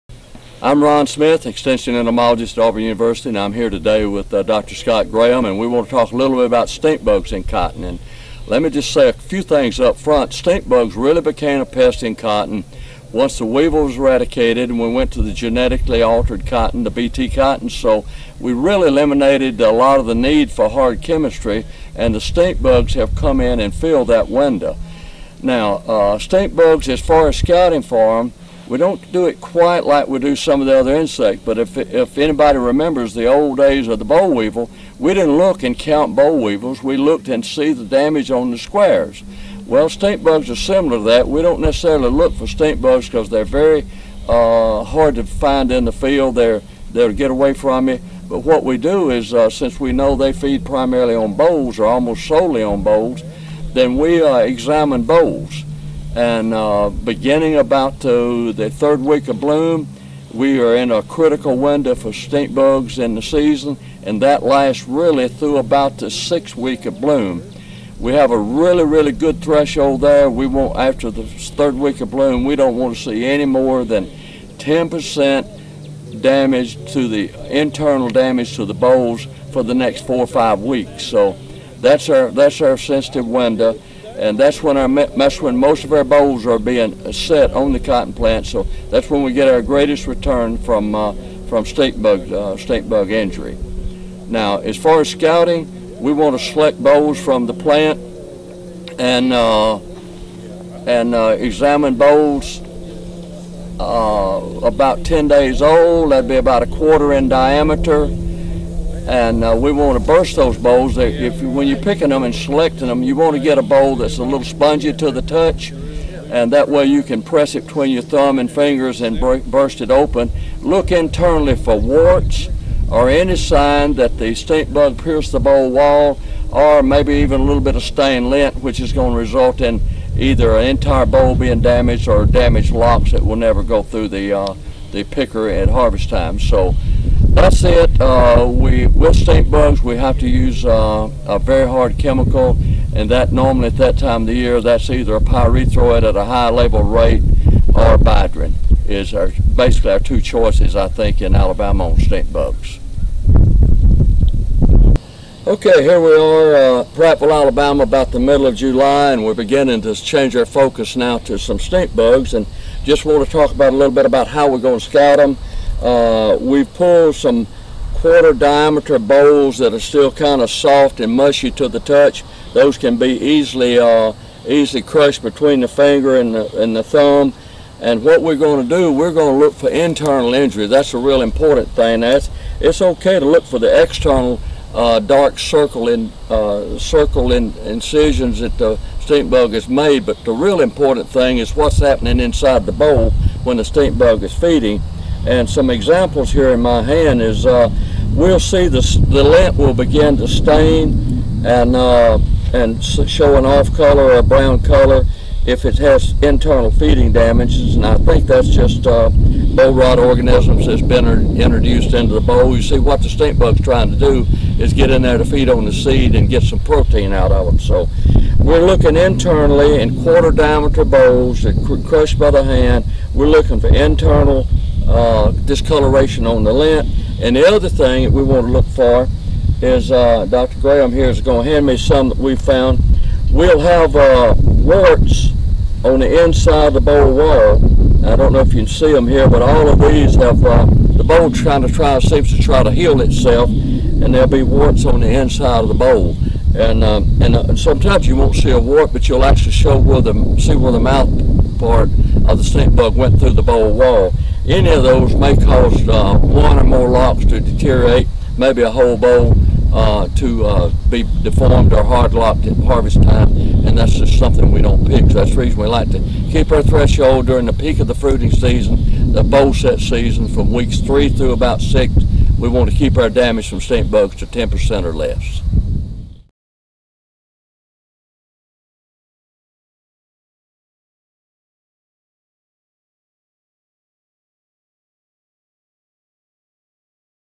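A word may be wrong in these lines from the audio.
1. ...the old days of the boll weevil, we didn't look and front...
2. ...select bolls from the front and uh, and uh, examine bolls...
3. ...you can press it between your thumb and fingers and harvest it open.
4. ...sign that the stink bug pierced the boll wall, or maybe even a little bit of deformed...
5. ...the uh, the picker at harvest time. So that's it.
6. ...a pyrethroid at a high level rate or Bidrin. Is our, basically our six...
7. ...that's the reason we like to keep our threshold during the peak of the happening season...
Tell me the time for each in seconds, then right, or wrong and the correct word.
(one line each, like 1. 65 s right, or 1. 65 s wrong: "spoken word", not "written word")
1. 33 s wrong: "count", not "front"
2. 96 s wrong: "plant", not "front"
3. 116 s wrong: "burst", not "harvest"
4. 123 s wrong: "stained", not "deformed"
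5. 134 s right
6. 145 s wrong: "two", not "six"
7. 265 s wrong: "fruiting", not "happening".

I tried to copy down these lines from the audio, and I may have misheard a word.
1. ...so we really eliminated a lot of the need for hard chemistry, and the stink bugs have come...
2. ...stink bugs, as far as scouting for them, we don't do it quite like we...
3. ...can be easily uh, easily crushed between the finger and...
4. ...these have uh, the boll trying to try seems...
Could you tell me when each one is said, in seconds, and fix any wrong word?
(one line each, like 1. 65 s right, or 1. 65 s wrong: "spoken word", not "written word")
1. 17 s right
2. 26 s right
3. 172 s right
4. 239 s right.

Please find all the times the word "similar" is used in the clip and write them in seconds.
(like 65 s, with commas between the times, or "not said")
40 s.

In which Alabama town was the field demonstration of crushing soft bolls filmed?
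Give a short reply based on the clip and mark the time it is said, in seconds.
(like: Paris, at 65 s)
Prattville, at 156 s.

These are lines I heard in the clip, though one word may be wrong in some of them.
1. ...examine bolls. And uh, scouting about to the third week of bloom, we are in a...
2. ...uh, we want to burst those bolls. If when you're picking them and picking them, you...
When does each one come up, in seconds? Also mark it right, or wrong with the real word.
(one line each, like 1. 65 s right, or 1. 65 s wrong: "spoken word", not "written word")
1. 54 s wrong: "beginning", not "scouting"
2. 109 s wrong: "selecting", not "picking".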